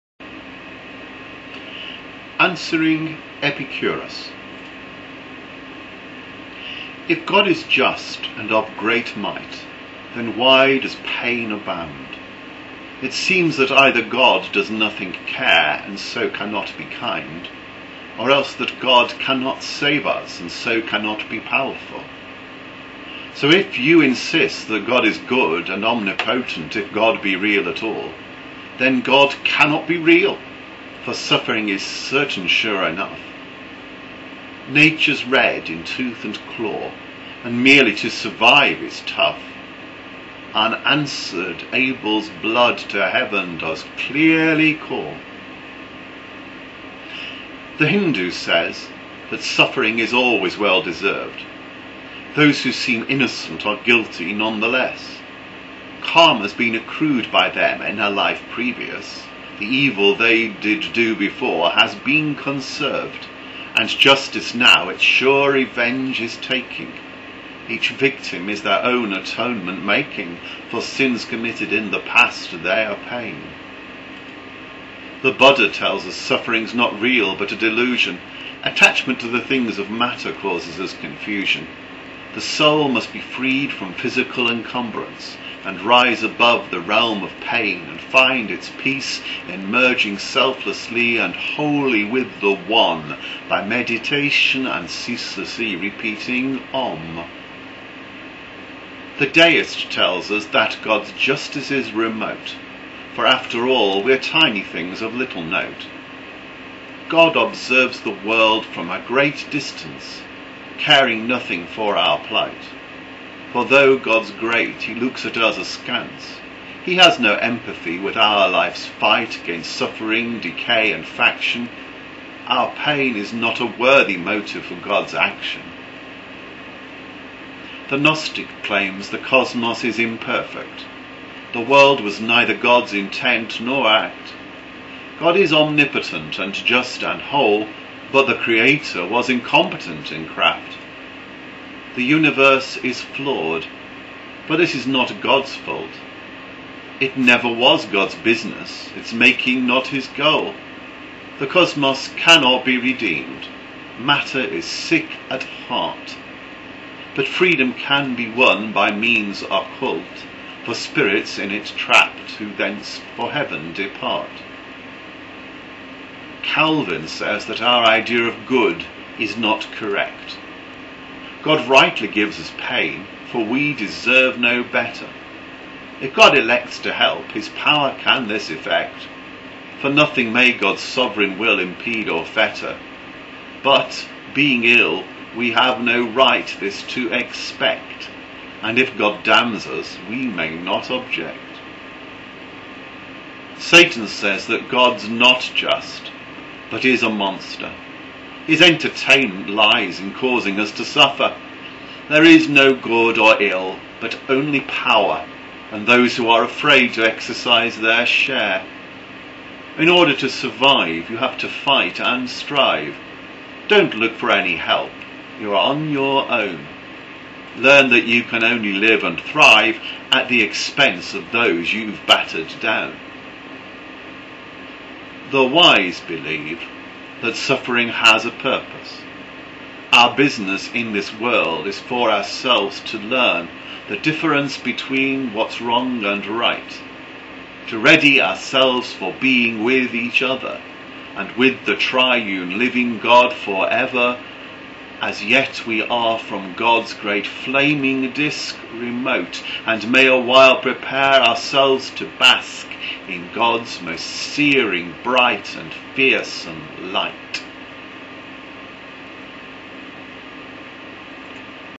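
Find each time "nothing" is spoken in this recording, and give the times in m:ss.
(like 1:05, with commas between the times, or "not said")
0:14, 1:51, 2:59.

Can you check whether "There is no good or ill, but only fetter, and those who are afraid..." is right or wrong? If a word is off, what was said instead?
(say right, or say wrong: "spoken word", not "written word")
wrong: "power", not "fetter".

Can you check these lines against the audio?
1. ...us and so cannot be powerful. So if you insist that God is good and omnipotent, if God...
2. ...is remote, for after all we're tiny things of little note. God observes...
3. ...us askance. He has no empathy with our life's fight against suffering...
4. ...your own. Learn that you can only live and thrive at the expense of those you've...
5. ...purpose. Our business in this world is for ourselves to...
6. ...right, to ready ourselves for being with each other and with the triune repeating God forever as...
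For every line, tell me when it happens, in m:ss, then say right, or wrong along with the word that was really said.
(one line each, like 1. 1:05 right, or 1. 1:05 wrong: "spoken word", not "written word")
1. 0:20 right
2. 1:41 right
3. 1:55 right
4. 3:35 right
5. 3:48 right
6. 3:56 wrong: "living", not "repeating".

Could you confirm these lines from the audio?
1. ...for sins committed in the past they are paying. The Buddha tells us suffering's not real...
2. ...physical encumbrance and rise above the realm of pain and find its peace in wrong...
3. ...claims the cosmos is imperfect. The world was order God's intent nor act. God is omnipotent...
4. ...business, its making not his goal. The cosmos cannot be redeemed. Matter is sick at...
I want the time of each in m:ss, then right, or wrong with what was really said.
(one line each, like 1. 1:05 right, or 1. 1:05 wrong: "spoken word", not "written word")
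1. 1:10 right
2. 1:23 wrong: "merging", not "wrong"
3. 2:08 wrong: "neither", not "order"
4. 2:28 right.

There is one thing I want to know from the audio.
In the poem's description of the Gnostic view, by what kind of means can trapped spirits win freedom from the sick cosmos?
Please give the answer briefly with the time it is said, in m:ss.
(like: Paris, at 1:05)
occult, at 2:39.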